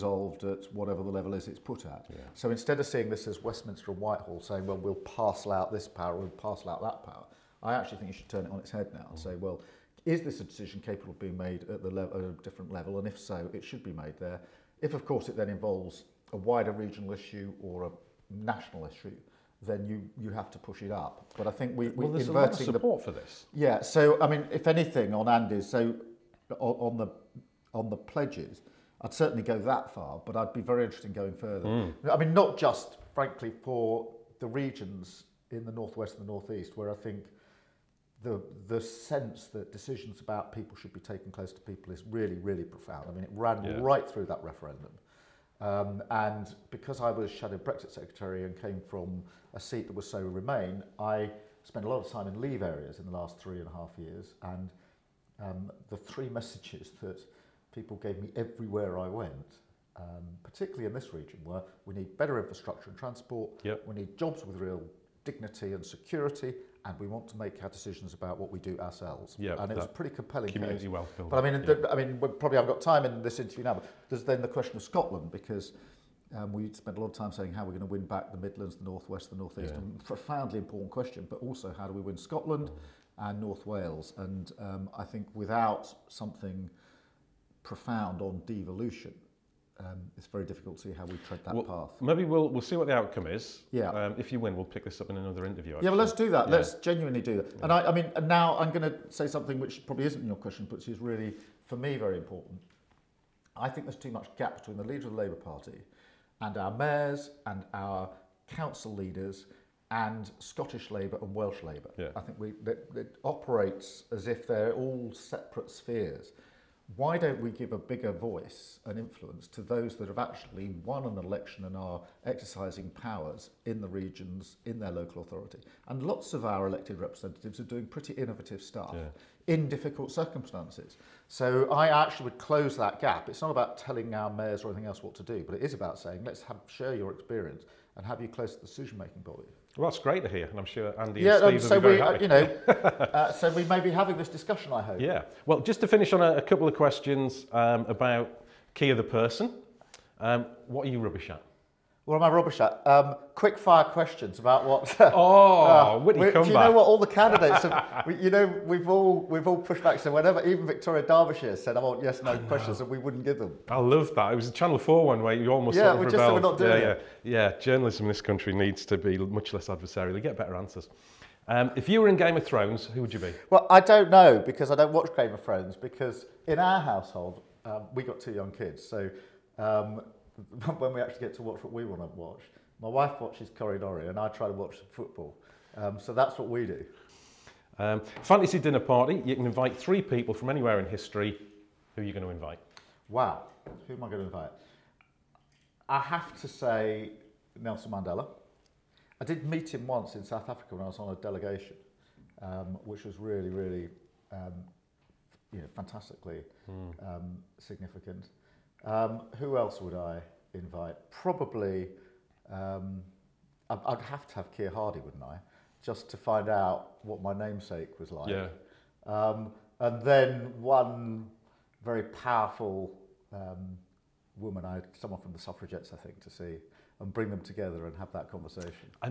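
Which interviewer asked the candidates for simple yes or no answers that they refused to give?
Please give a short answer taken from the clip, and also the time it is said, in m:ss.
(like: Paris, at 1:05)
Victoria Derbyshire, at 2:40.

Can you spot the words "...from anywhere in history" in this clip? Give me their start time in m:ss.
3:10.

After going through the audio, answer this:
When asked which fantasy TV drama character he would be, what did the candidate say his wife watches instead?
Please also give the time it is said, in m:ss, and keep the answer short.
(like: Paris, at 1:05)
Corridori, at 3:03.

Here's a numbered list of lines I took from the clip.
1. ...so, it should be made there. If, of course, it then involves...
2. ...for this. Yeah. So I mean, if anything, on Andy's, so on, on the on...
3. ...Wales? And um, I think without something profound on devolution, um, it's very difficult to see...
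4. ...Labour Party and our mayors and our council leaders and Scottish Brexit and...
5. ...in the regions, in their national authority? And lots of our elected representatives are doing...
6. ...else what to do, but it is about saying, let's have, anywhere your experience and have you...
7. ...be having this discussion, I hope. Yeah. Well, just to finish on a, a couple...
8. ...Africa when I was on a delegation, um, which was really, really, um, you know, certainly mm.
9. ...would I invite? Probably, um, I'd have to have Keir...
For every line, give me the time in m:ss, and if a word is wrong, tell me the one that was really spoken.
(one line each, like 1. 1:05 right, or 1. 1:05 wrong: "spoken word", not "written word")
1. 0:13 right
2. 0:23 right
3. 1:23 right
4. 1:45 wrong: "Labour", not "Brexit"
5. 2:03 wrong: "local", not "national"
6. 2:14 wrong: "share", not "anywhere"
7. 2:23 right
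8. 3:20 wrong: "fantastically", not "certainly"
9. 3:29 right.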